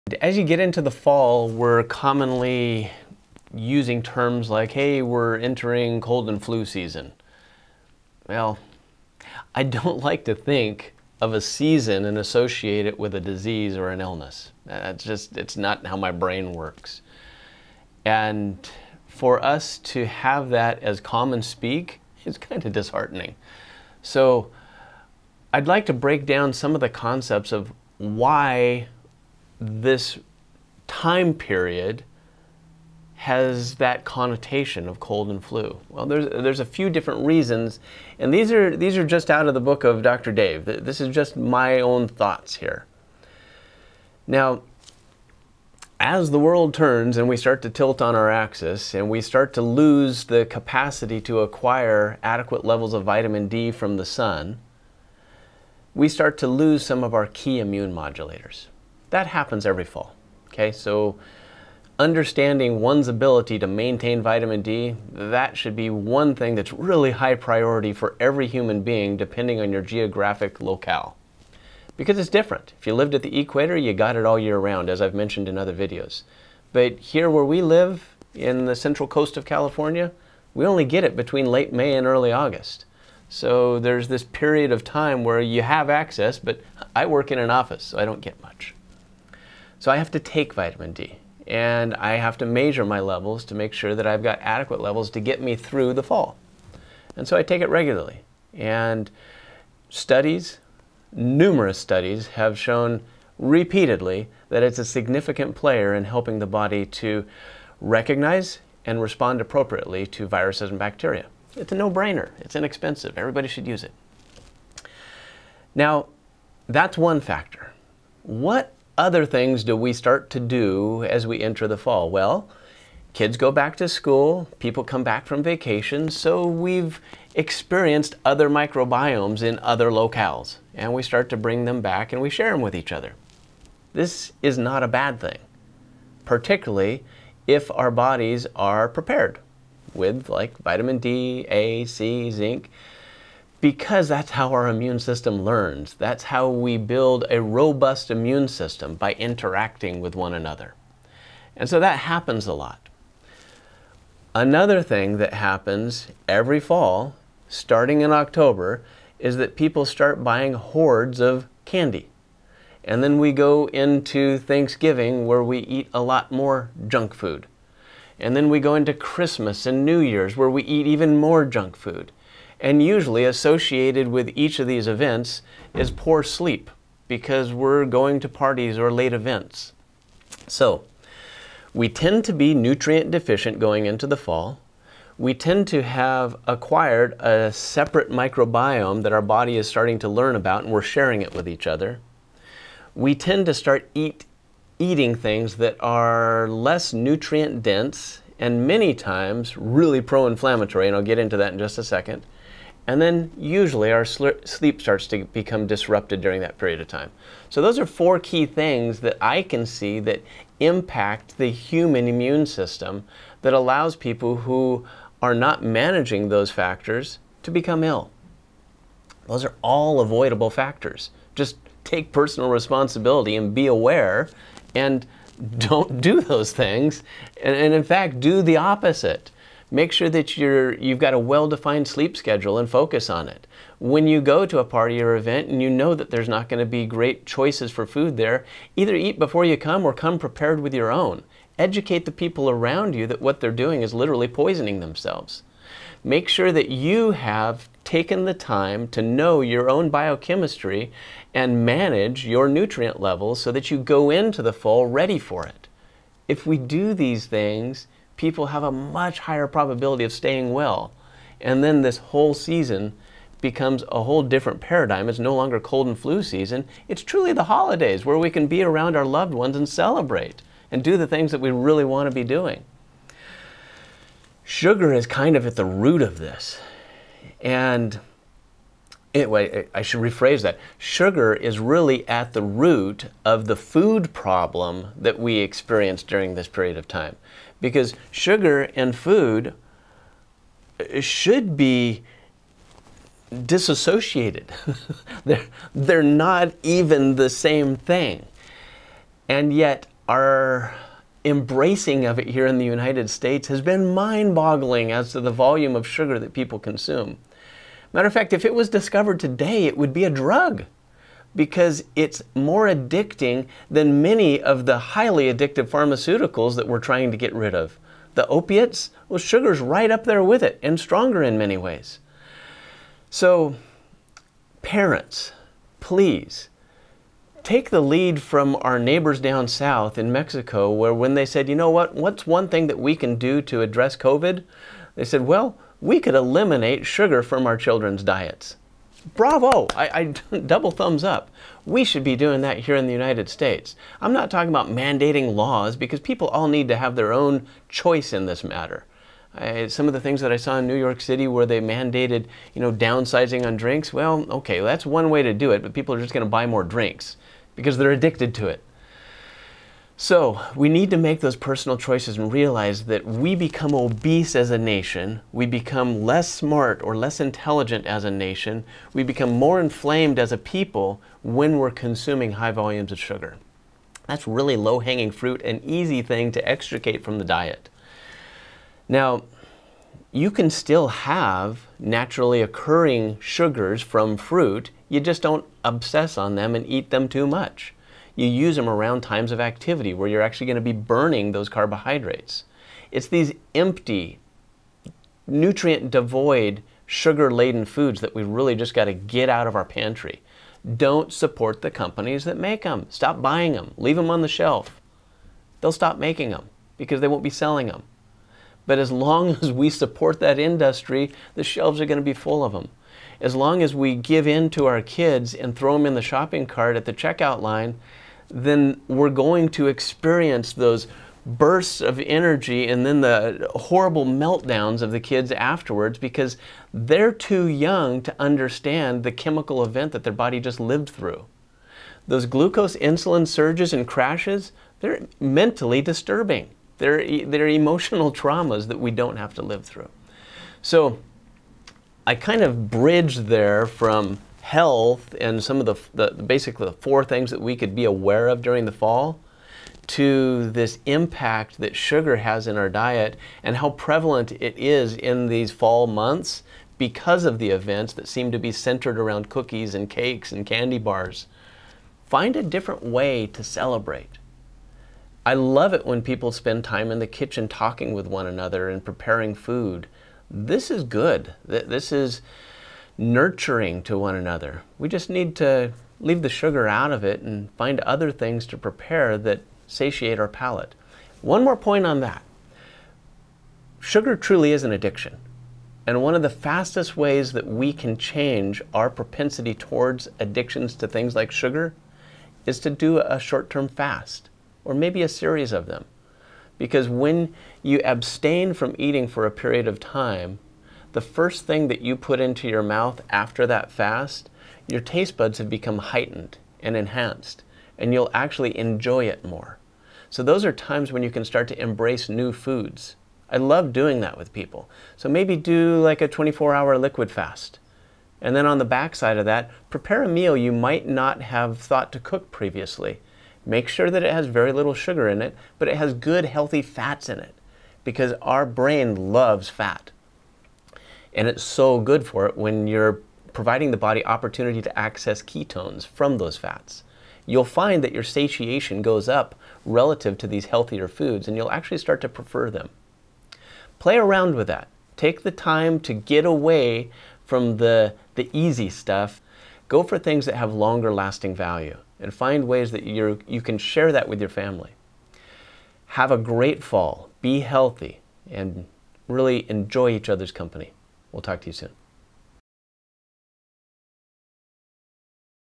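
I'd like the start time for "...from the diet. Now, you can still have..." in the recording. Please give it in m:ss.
6:17.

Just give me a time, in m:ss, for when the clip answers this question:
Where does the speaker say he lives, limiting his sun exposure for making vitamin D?
1:18.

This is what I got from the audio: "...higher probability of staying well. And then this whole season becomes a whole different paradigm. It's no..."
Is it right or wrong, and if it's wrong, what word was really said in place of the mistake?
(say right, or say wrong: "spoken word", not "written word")
right.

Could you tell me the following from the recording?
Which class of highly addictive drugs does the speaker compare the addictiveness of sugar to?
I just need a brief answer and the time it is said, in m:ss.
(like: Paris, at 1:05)
Opiates, at 5:18.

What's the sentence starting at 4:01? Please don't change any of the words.
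Educate the people around you that what they're doing is literally poisoning themselves.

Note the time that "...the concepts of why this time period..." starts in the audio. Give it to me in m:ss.
0:26.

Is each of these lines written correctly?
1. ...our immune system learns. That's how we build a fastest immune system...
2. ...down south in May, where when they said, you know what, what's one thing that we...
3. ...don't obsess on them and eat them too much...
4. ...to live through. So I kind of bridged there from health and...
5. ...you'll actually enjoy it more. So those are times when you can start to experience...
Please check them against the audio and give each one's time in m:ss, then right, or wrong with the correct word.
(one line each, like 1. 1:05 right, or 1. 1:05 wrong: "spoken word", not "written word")
1. 2:24 wrong: "robust", not "fastest"
2. 5:29 wrong: "Mexico", not "May"
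3. 6:25 right
4. 7:19 right
5. 8:27 wrong: "embrace", not "experience".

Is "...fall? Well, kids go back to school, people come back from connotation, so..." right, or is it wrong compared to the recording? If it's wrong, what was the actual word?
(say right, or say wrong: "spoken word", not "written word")
wrong: "vacation", not "connotation".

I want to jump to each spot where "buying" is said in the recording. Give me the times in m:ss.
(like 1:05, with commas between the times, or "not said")
2:40, 6:43.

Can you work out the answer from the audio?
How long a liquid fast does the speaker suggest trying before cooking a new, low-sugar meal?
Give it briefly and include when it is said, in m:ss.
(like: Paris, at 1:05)
24 hours, at 8:36.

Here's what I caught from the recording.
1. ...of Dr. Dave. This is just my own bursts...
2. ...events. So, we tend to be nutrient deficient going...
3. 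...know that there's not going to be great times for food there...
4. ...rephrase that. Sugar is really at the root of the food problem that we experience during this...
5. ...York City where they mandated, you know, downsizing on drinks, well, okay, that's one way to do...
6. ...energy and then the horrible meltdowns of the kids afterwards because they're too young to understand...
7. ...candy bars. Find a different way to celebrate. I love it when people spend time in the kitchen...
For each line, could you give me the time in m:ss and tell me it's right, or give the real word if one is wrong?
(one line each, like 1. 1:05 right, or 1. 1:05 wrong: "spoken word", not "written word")
1. 0:39 wrong: "thoughts", not "bursts"
2. 2:59 right
3. 3:55 wrong: "choices", not "times"
4. 4:40 right
5. 5:50 right
6. 7:01 right
7. 7:40 right.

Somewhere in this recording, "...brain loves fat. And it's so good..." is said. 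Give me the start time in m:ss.
8:48.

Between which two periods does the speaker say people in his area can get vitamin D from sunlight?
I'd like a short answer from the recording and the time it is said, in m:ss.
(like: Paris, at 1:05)
Late May and early August, at 1:21.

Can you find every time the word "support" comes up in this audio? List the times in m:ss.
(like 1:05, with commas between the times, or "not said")
6:41, 6:49.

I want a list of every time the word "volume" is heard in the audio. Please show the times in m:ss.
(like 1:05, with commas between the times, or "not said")
5:05, 6:12.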